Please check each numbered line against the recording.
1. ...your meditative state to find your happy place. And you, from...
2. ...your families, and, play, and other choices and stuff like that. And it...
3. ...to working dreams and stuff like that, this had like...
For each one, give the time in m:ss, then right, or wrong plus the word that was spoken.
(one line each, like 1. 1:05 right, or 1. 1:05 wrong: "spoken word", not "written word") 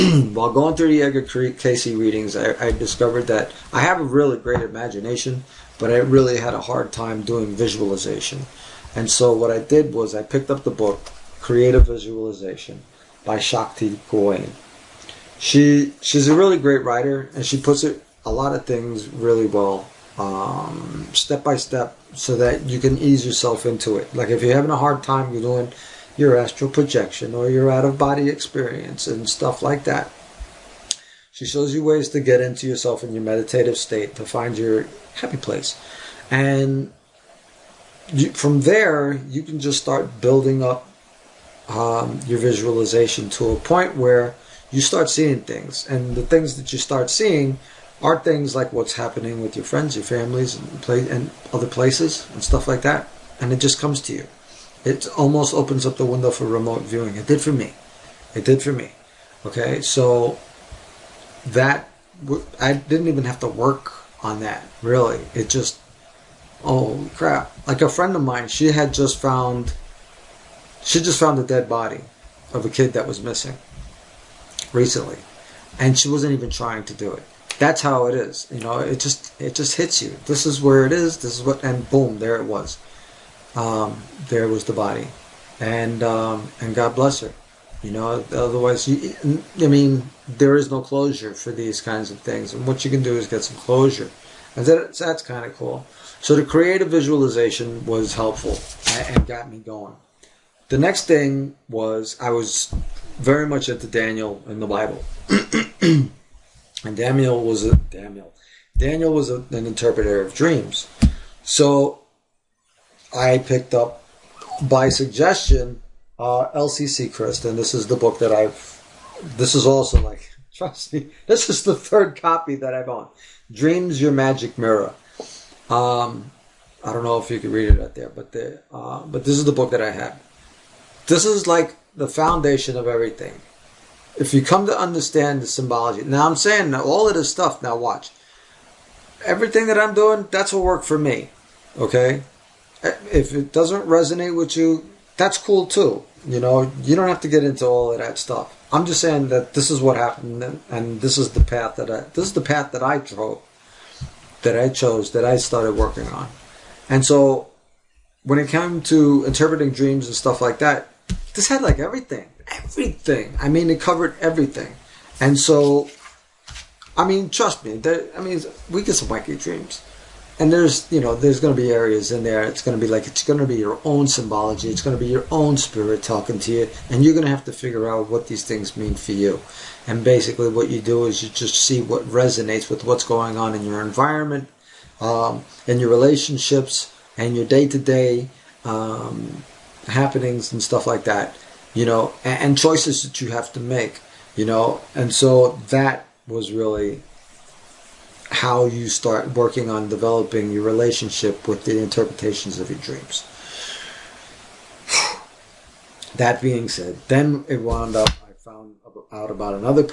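1. 0:33 right
2. 0:49 wrong: "places", not "choices"
3. 2:38 wrong: "interpreting", not "working".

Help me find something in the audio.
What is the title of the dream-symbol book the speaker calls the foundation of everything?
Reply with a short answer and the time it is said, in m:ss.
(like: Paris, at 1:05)
Dreams Your Magic Mirror, at 2:03.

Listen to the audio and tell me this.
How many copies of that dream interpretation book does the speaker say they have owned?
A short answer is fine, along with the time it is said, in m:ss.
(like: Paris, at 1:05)
3, at 2:01.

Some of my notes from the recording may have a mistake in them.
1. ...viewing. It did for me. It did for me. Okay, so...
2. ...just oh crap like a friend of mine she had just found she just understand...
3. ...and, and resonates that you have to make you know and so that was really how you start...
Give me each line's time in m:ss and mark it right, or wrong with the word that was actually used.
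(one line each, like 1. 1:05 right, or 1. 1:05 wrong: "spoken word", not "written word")
1. 0:56 right
2. 1:05 wrong: "found", not "understand"
3. 3:12 wrong: "choices", not "resonates".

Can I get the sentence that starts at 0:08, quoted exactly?
And so what I did was I picked up the book, Creative Visualization, by Shakti Gawain.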